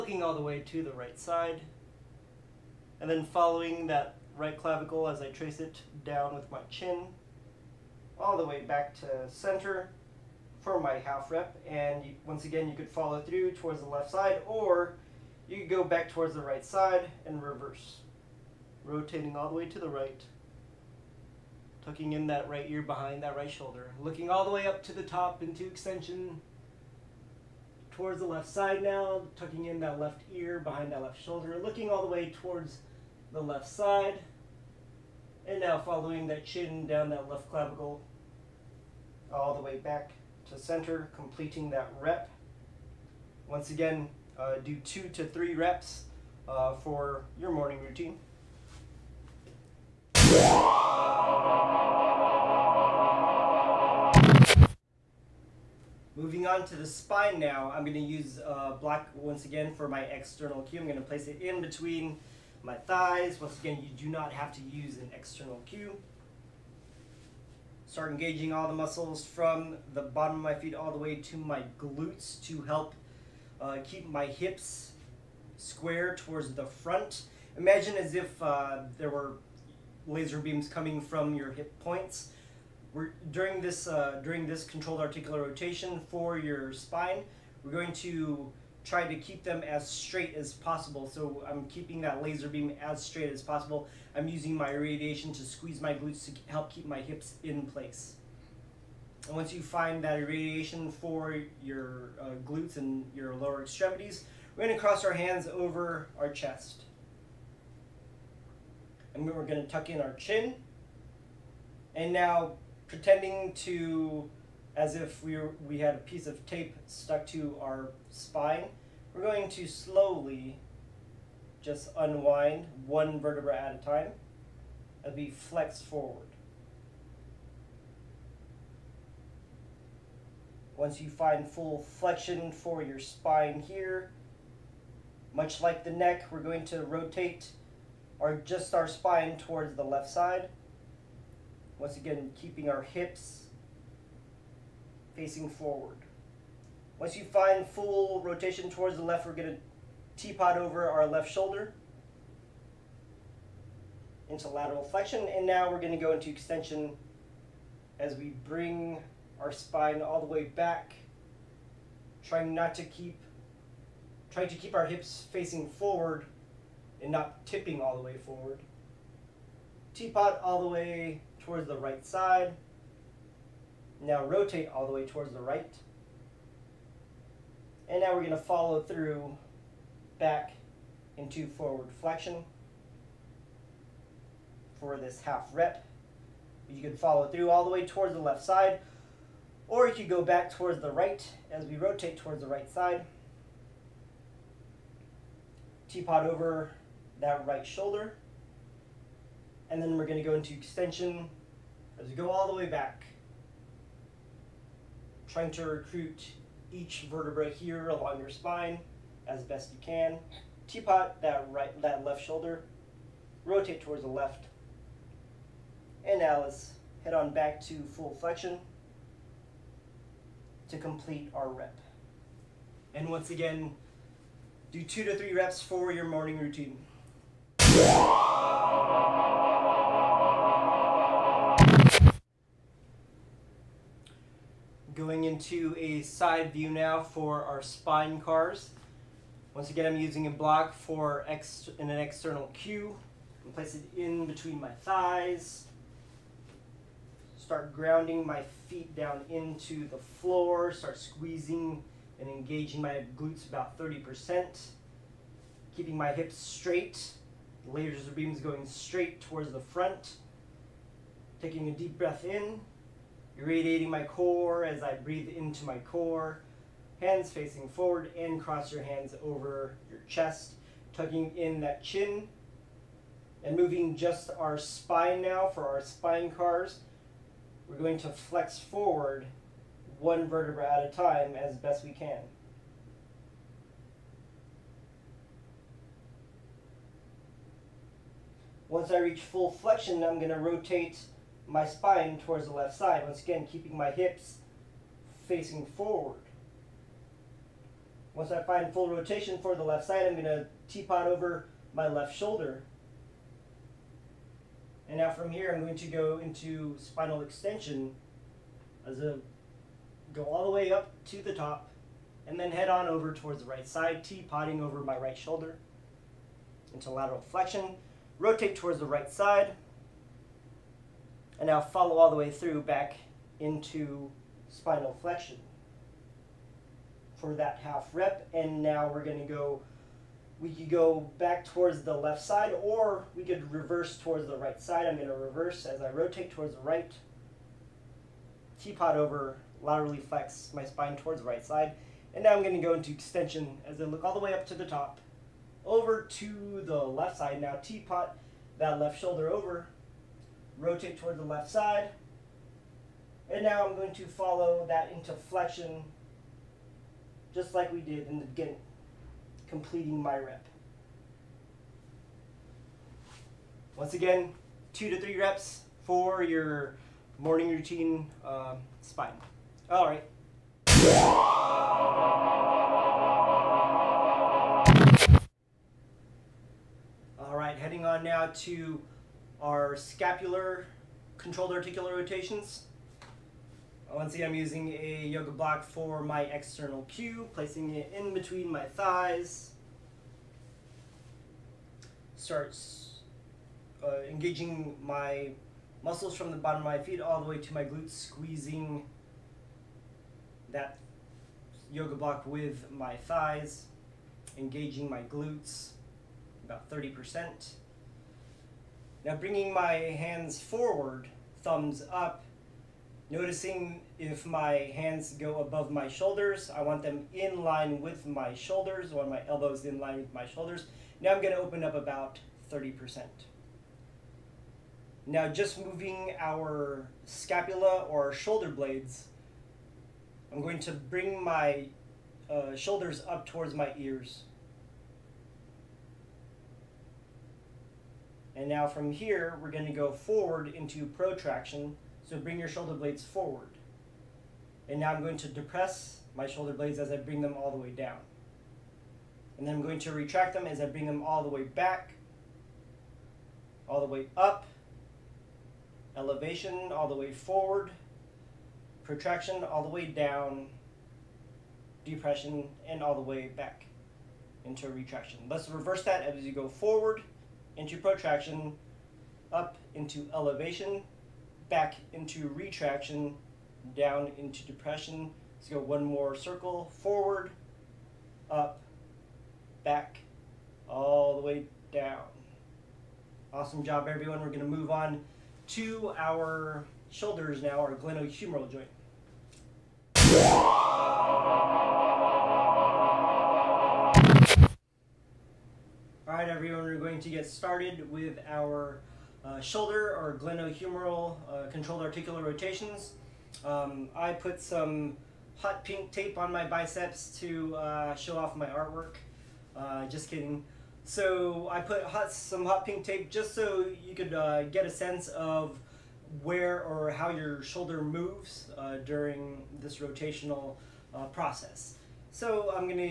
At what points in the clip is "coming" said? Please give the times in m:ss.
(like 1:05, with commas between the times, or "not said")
1:20, 3:55.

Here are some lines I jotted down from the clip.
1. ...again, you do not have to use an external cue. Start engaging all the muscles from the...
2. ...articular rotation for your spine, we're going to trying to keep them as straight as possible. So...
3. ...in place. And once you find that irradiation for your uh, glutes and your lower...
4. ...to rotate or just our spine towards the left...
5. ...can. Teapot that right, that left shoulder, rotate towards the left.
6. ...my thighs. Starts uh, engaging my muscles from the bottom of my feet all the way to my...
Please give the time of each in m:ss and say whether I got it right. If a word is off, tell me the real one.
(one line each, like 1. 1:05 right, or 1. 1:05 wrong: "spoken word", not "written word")
1. 1:03 right
2. 1:25 right
3. 1:37 right
4. 2:16 right
5. 3:29 right
6. 6:28 right.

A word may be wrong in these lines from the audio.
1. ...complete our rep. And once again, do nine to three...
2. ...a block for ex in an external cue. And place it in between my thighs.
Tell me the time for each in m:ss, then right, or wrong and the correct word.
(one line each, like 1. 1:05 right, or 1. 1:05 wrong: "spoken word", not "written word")
1. 3:40 wrong: "two", not "nine"
2. 4:00 right.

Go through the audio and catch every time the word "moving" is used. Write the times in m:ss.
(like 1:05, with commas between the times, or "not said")
0:56, 4:33, 7:05.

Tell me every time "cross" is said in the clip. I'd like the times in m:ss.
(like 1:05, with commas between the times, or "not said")
1:44, 4:28.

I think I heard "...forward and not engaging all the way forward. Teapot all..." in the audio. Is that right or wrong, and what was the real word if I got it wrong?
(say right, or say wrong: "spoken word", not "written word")
wrong: "tipping", not "engaging".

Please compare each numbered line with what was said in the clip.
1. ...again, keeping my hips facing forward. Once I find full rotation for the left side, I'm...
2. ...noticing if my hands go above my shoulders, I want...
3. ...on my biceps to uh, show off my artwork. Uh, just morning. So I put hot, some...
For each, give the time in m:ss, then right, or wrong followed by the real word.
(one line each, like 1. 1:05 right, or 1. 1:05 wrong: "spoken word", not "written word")
1. 4:53 right
2. 6:53 right
3. 8:26 wrong: "kidding", not "morning".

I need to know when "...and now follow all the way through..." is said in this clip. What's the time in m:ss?
5:21.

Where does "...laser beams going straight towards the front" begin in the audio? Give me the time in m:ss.
4:17.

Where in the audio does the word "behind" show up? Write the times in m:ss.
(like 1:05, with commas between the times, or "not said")
0:22, 0:30.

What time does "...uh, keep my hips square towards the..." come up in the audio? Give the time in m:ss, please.
1:13.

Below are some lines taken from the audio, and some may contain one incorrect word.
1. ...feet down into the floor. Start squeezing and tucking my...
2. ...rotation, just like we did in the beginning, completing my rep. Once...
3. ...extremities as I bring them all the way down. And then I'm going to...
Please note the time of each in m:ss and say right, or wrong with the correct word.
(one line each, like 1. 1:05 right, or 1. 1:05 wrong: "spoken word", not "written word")
1. 4:08 wrong: "engaging", not "tucking"
2. 5:55 wrong: "flexion", not "rotation"
3. 7:26 wrong: "blades", not "extremities".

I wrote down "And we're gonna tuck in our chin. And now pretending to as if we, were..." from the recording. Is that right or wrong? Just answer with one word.
right.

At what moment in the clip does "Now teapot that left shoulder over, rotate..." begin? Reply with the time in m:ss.
5:47.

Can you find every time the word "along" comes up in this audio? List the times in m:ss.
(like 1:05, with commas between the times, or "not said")
3:27.